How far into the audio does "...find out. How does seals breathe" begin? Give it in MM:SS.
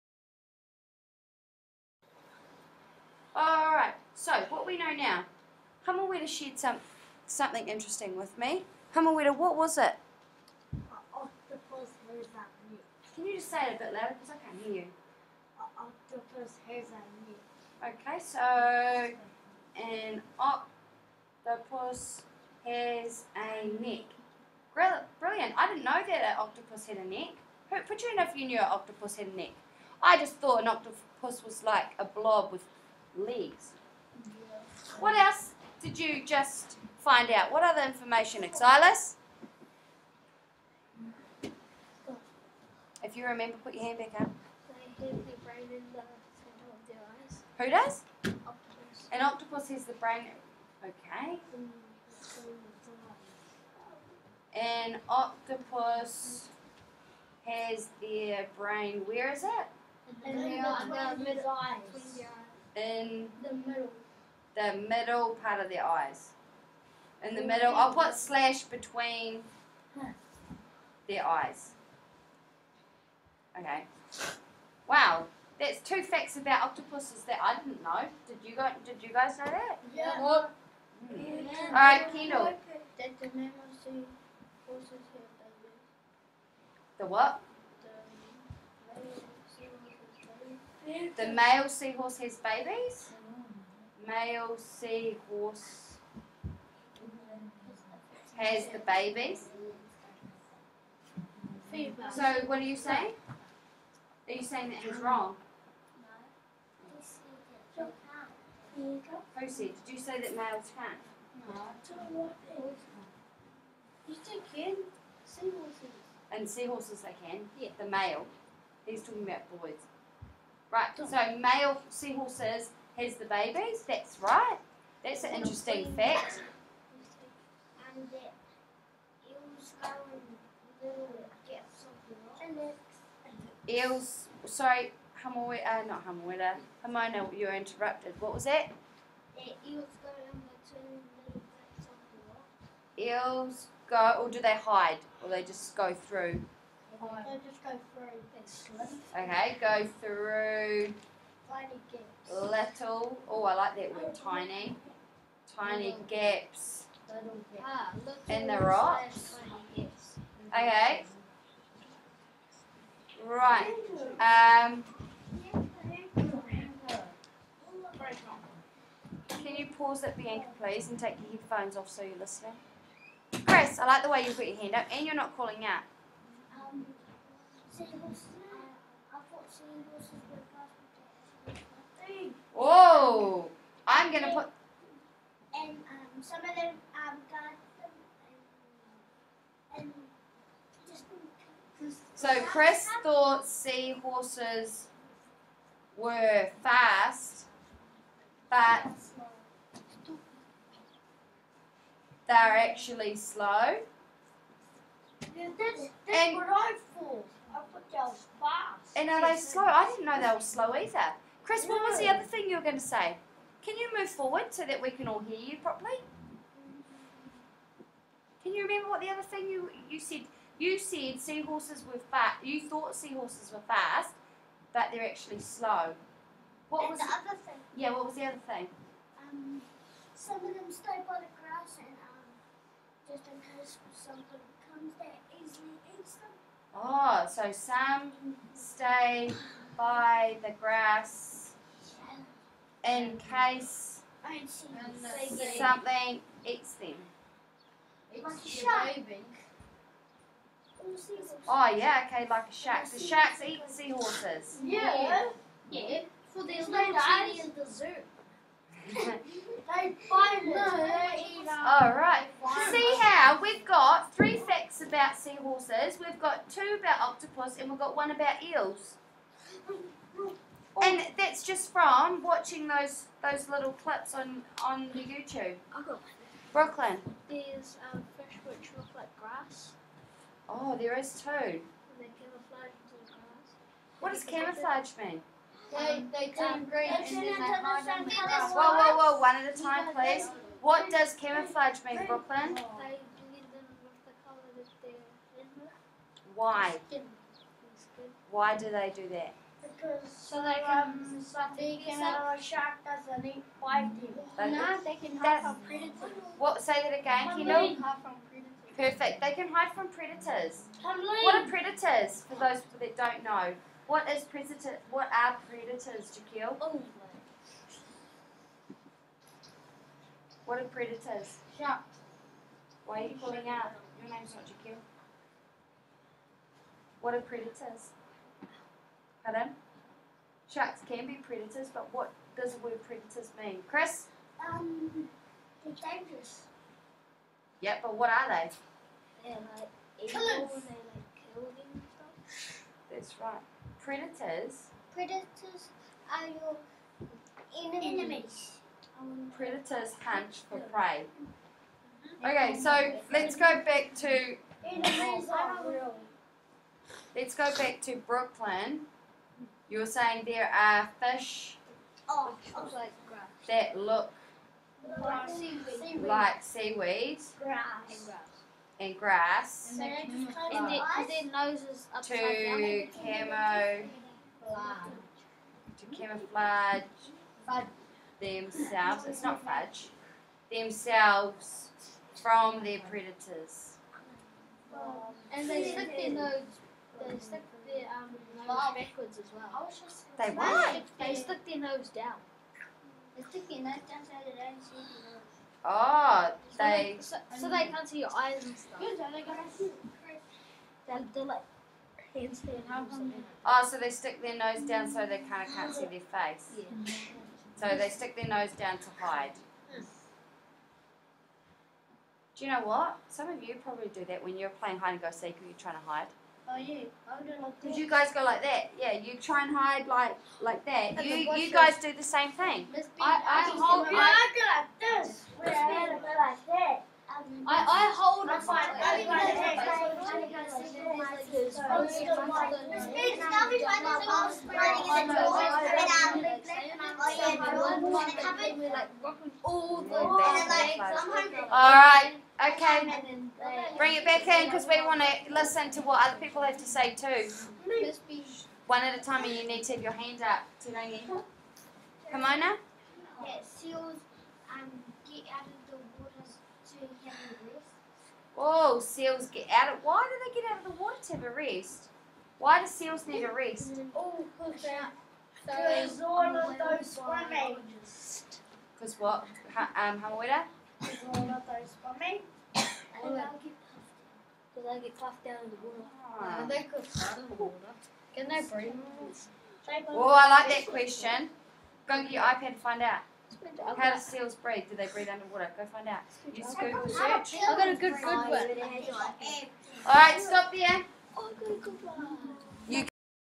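08:02.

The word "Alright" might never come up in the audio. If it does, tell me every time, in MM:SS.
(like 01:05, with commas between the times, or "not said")
04:21, 07:21.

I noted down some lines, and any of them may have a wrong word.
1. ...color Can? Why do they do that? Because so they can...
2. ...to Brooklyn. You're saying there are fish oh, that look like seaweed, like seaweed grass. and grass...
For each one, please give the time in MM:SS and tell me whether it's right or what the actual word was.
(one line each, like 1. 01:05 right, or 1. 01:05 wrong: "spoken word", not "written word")
1. 04:54 wrong: "Why", not "Can"
2. 05:57 right.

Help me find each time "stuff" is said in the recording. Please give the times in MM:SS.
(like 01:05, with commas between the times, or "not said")
05:42, 06:38.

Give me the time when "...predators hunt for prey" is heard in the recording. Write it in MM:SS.
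05:49.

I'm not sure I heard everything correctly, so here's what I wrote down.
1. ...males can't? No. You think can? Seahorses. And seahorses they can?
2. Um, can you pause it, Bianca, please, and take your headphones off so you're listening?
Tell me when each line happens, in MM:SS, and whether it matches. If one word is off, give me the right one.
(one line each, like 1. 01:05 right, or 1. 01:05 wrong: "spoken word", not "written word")
1. 01:50 right
2. 02:44 right.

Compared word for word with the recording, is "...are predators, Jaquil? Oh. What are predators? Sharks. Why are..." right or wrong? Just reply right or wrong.
right.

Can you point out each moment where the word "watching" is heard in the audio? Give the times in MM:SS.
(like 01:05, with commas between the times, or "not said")
04:32.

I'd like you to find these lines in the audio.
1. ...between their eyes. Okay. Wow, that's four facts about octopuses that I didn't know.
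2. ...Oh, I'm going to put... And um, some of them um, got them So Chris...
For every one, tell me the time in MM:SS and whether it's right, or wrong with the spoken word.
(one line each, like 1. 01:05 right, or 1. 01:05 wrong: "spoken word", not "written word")
1. 01:08 wrong: "two", not "four"
2. 03:02 right.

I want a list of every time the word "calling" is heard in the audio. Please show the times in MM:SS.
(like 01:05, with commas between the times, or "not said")
02:55, 05:23.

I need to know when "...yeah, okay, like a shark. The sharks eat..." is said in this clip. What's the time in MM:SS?
04:11.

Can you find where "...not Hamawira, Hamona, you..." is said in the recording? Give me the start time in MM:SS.
02:15.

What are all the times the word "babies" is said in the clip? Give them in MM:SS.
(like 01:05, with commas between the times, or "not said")
01:32, 01:38, 02:03.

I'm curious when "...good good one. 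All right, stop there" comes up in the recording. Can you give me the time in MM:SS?
08:07.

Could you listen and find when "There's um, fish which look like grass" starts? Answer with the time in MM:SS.
04:37.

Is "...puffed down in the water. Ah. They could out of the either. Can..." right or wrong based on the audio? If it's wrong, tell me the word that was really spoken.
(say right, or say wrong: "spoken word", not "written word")
wrong: "water", not "either".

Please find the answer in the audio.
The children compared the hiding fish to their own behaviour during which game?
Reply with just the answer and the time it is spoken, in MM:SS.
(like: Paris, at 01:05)
hide and go seek, at 06:54.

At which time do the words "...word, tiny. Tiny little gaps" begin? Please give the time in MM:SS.
02:33.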